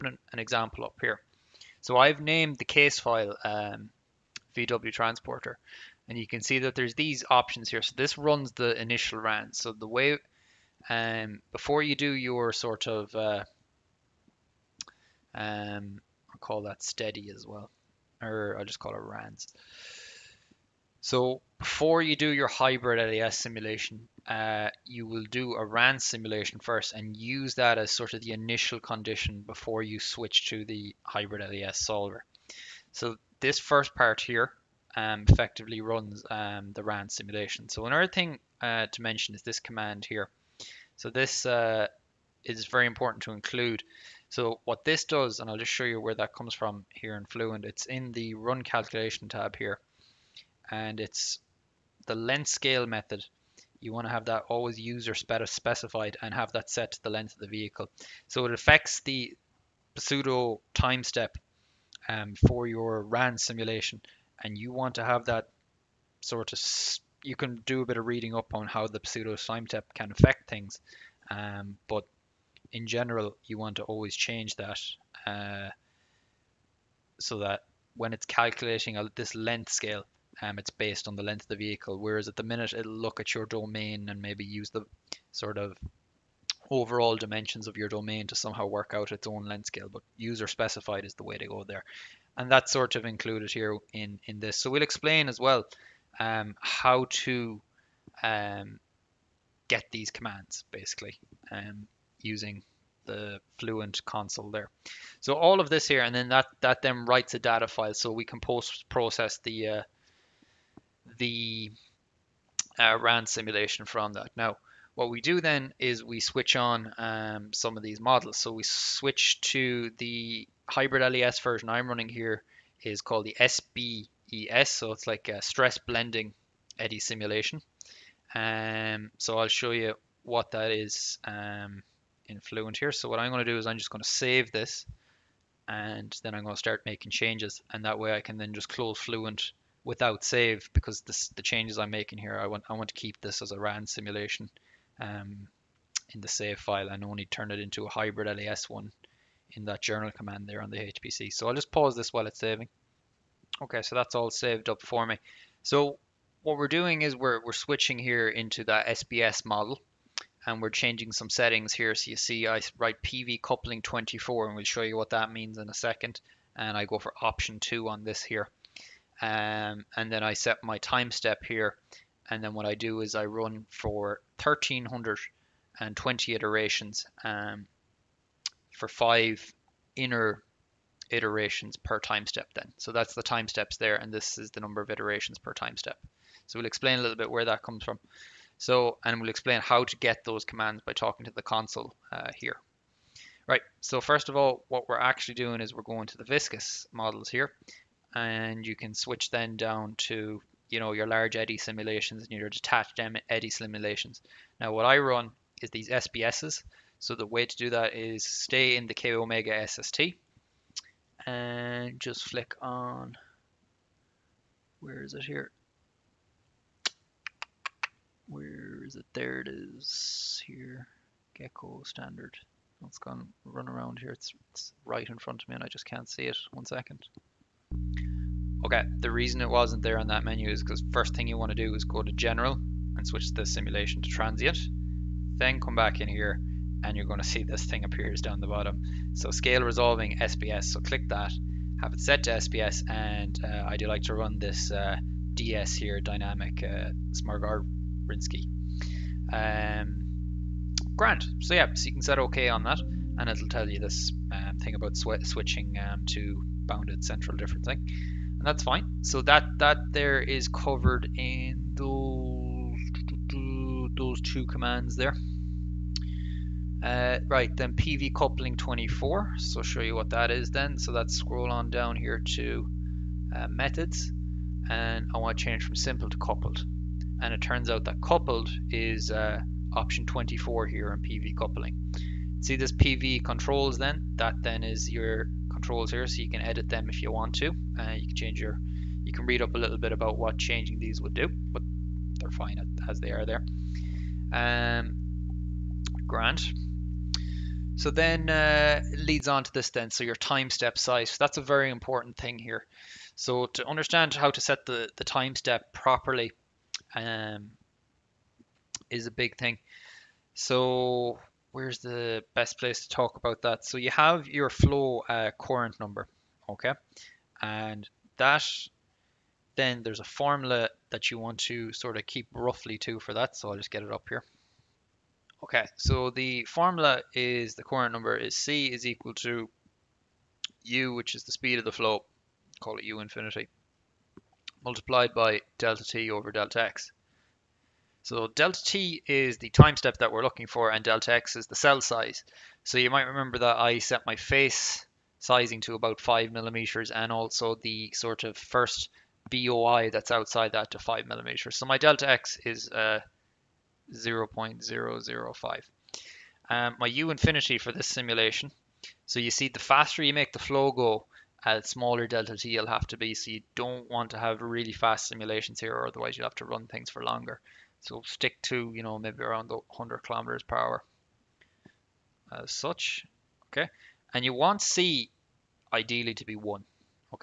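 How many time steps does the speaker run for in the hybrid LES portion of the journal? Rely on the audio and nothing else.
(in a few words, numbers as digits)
1320.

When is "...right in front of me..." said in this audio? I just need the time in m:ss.
3:44.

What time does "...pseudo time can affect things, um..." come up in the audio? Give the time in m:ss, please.
1:09.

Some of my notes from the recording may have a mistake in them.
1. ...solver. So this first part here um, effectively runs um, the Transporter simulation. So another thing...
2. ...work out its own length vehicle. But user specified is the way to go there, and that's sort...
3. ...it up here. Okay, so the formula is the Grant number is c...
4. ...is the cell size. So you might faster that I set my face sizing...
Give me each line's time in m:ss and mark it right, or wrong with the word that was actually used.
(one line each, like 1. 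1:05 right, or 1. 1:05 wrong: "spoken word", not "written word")
1. 0:31 wrong: "RAN", not "Transporter"
2. 1:28 wrong: "scale", not "vehicle"
3. 5:23 wrong: "Courant", not "Grant"
4. 5:41 wrong: "remember", not "faster".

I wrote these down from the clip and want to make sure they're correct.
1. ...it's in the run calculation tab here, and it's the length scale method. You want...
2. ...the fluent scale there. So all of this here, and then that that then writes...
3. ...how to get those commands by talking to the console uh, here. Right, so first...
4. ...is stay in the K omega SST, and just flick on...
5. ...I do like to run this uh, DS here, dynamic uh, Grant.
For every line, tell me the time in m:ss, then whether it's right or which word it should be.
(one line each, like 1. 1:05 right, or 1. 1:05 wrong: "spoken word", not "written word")
1. 0:47 right
2. 1:43 wrong: "console", not "scale"
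3. 3:09 right
4. 3:27 right
5. 4:03 right.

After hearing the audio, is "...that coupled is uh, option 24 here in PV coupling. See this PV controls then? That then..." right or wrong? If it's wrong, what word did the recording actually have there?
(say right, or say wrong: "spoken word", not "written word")
right.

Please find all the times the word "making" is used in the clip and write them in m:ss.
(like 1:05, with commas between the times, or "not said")
2:16, 2:21.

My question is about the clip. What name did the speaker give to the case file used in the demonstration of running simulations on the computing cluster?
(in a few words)
VW Transporter.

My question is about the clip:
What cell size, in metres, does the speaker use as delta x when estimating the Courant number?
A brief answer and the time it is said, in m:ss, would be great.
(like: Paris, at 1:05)
0.005, at 5:53.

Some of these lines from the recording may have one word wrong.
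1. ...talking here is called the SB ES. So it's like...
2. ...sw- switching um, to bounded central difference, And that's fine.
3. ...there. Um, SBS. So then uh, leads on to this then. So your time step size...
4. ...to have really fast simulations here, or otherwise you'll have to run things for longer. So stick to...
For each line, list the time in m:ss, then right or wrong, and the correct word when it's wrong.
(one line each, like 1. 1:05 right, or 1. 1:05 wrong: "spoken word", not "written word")
1. 2:01 wrong: "running", not "talking"
2. 4:14 right
3. 4:53 wrong: "Grant", not "SBS"
4. 6:04 right.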